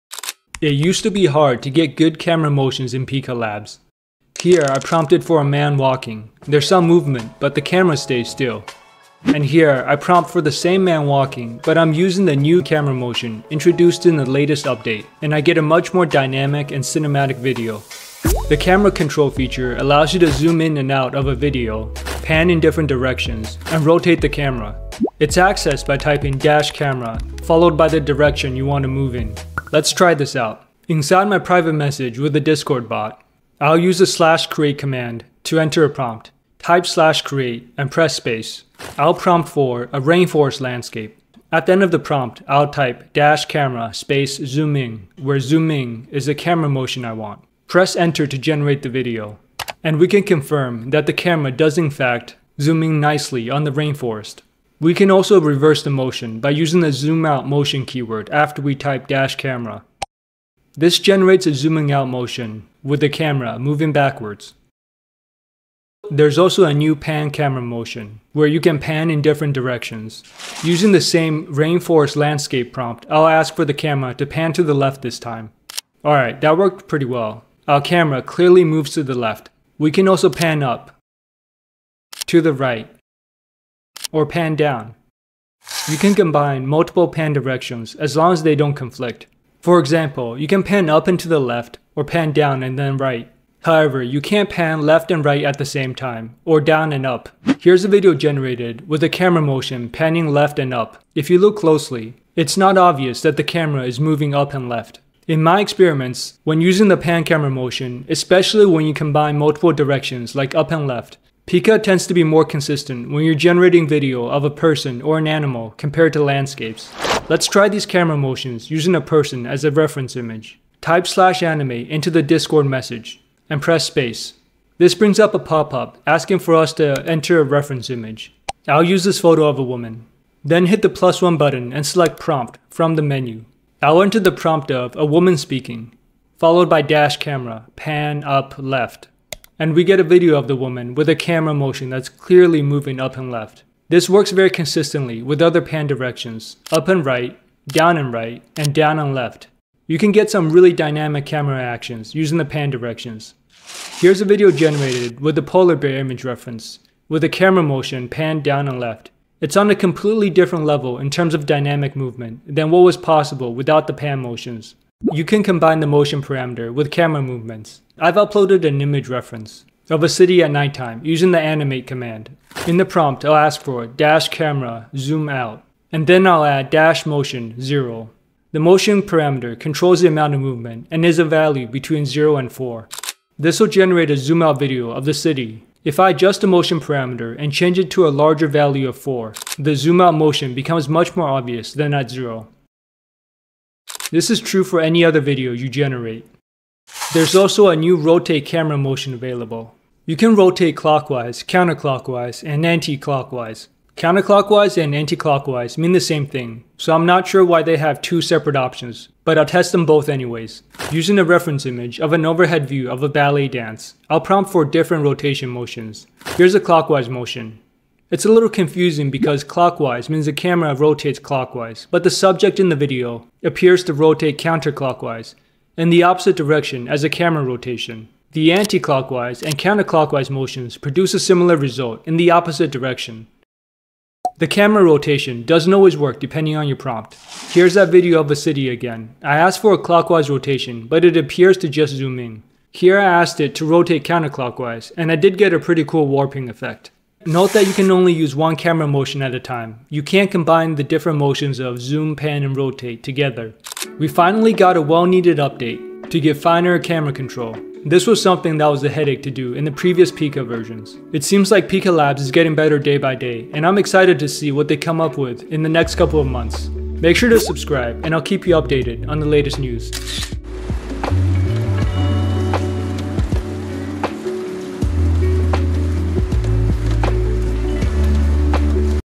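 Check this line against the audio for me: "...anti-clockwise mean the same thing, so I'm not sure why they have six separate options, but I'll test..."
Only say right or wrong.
wrong.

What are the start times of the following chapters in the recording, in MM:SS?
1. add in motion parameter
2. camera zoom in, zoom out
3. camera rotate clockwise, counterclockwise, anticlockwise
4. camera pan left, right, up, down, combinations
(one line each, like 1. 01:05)
1. 02:44
2. 00:29
3. 03:17
4. 01:05.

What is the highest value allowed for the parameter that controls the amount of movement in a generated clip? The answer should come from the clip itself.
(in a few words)
4.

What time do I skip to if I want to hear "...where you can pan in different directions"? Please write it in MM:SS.
01:08.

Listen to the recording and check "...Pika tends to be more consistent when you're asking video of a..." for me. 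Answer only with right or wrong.
wrong.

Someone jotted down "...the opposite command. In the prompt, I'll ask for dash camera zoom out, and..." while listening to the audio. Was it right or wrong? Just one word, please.
wrong.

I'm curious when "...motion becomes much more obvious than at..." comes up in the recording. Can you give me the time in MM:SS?
03:10.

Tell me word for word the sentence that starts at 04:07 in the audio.
Note that you can only use one camera motion at a time.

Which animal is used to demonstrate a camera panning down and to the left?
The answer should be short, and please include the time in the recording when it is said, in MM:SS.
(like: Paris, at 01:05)
Polar bear, at 02:35.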